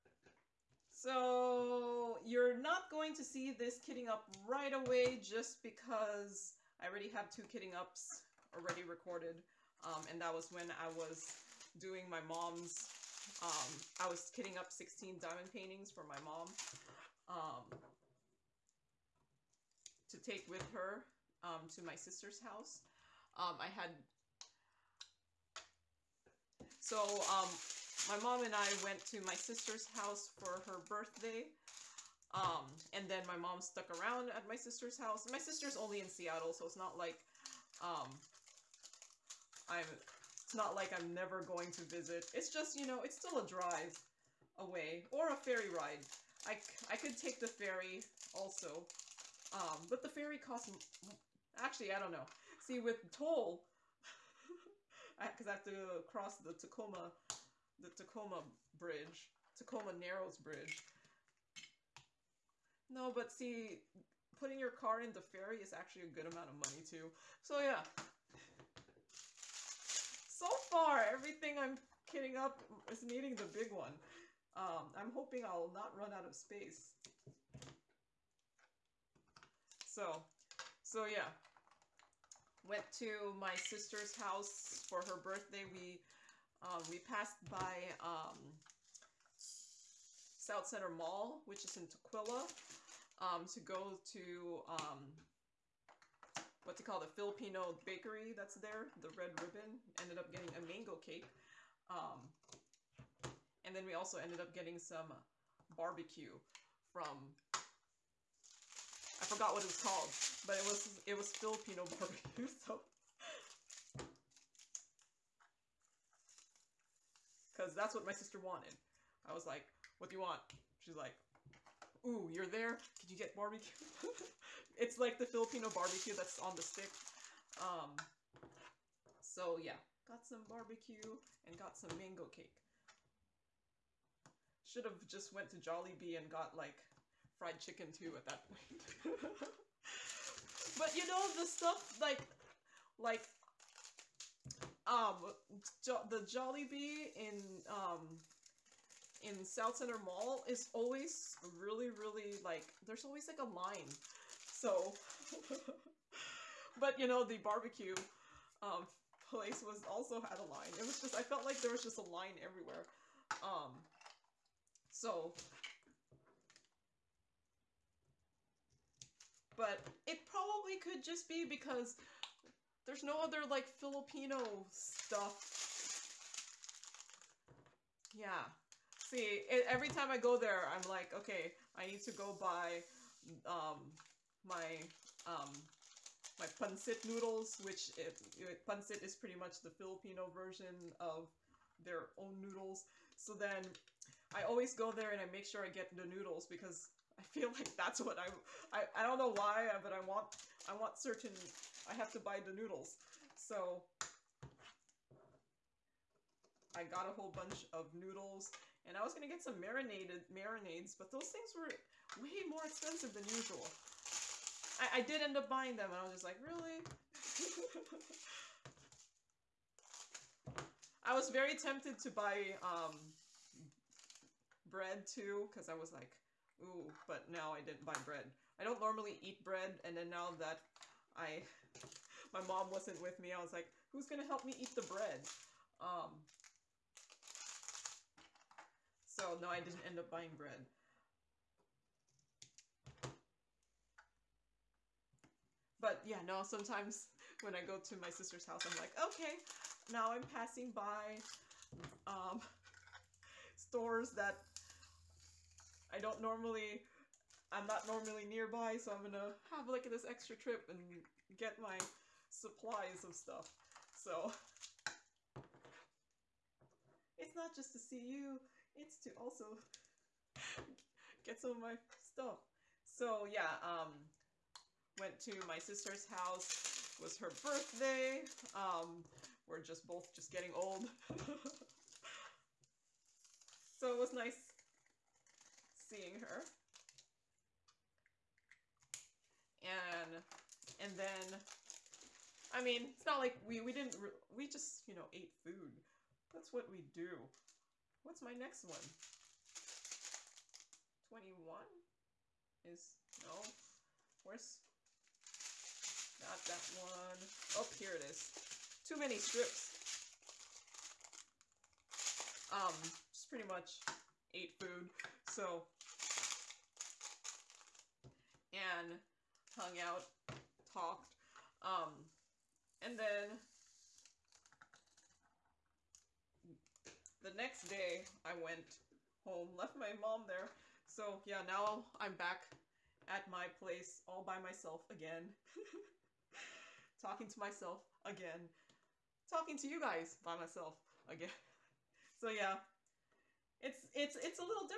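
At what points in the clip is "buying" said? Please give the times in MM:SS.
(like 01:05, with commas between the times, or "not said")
03:35, 04:00.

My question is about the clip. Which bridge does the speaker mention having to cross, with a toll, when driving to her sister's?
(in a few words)
Tacoma Narrows Bridge.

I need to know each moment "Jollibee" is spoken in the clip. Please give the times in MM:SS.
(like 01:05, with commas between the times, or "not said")
02:15, 02:26.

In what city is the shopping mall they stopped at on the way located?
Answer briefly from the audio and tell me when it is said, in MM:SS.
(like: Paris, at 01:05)
Tukwila, at 01:31.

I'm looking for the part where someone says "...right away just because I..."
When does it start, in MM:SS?
00:04.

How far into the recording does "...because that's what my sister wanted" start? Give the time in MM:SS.
01:57.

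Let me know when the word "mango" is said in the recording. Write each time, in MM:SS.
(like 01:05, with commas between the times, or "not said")
01:40, 02:11.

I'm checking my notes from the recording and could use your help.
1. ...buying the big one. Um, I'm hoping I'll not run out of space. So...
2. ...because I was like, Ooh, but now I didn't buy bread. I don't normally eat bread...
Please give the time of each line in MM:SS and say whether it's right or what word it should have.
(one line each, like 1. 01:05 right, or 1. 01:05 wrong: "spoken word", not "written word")
1. 01:13 wrong: "needing", not "buying"
2. 03:45 right.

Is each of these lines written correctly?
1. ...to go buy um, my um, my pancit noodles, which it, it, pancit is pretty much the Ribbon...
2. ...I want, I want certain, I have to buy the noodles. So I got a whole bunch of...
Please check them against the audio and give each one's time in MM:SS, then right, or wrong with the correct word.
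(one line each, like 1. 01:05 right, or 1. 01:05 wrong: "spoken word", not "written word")
1. 03:02 wrong: "Filipino", not "Ribbon"
2. 03:19 right.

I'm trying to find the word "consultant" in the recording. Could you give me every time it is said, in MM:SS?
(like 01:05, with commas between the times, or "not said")
not said.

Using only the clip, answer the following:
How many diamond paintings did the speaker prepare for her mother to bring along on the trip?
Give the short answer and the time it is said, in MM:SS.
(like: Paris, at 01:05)
16, at 00:14.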